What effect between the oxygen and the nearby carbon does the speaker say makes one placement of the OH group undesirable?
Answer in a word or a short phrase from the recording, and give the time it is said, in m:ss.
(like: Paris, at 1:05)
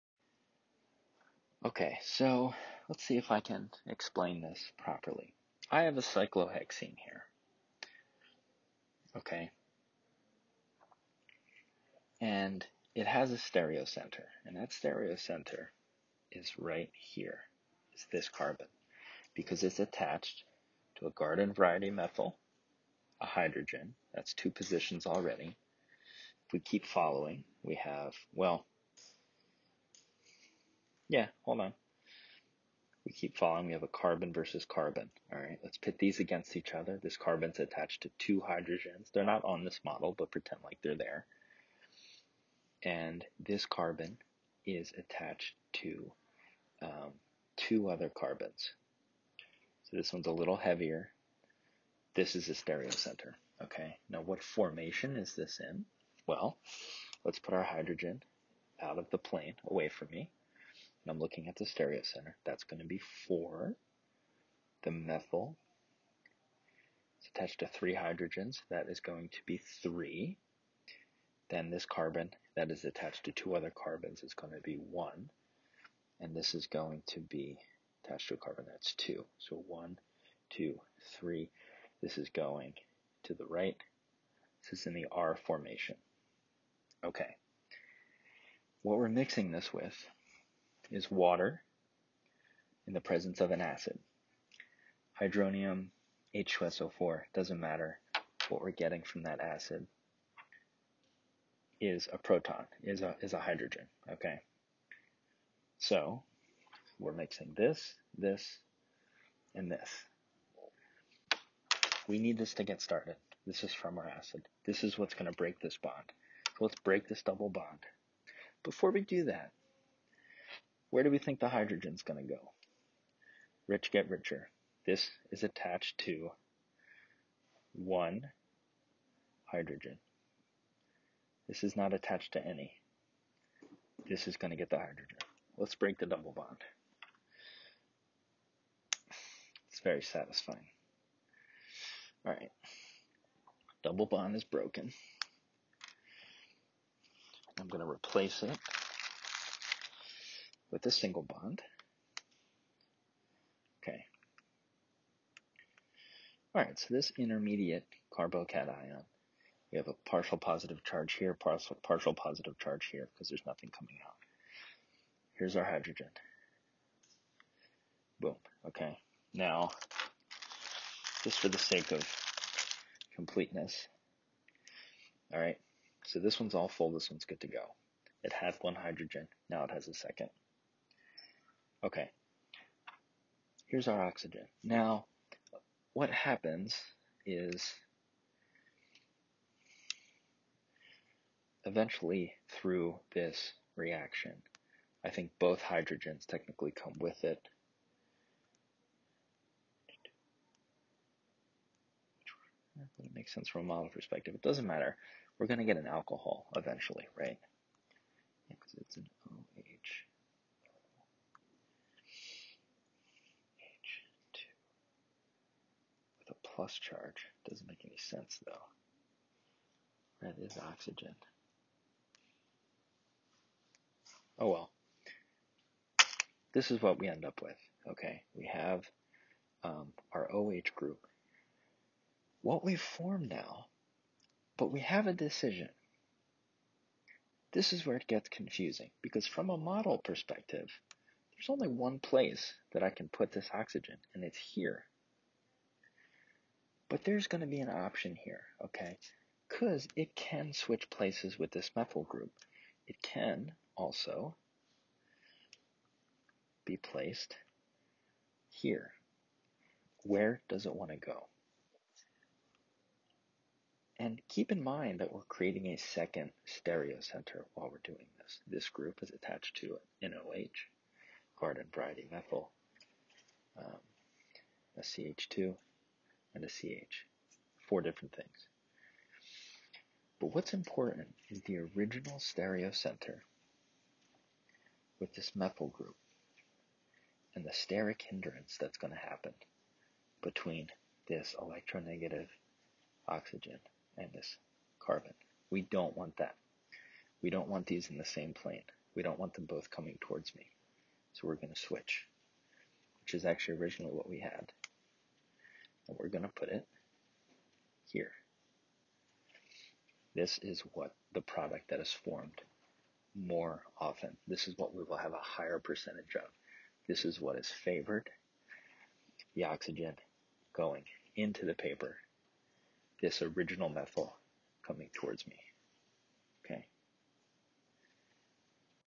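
steric hindrance, at 4:47.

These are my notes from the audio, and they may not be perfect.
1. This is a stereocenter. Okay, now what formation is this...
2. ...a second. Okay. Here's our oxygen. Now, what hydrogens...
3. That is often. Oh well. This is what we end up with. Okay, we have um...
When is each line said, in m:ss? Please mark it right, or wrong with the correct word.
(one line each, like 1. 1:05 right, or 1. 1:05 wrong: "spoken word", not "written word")
1. 0:52 right
2. 2:59 wrong: "happens", not "hydrogens"
3. 3:40 wrong: "oxygen", not "often".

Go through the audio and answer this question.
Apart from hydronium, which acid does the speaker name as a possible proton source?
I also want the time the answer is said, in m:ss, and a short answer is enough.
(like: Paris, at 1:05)
H2SO4, at 1:36.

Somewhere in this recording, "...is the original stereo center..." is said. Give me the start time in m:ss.
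4:41.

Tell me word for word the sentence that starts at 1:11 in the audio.
Then this carbon that is attached to two other carbons is going to be 1.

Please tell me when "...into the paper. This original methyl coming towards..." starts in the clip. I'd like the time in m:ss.
5:21.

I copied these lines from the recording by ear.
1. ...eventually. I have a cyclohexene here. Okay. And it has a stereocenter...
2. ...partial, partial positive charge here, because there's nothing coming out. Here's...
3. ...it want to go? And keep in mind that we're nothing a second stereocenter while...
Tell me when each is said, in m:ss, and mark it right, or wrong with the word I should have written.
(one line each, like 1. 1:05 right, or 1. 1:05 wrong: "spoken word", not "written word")
1. 0:04 wrong: "properly", not "eventually"
2. 2:41 right
3. 4:20 wrong: "creating", not "nothing".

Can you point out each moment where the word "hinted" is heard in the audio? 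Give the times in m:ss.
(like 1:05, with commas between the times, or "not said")
not said.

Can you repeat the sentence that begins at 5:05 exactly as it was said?
And we're going to put it here.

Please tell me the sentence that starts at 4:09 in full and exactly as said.
Because it can switch places with this methyl group.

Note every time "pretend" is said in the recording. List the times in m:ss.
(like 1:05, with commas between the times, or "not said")
0:40.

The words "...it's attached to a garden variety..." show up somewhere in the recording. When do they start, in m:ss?
0:19.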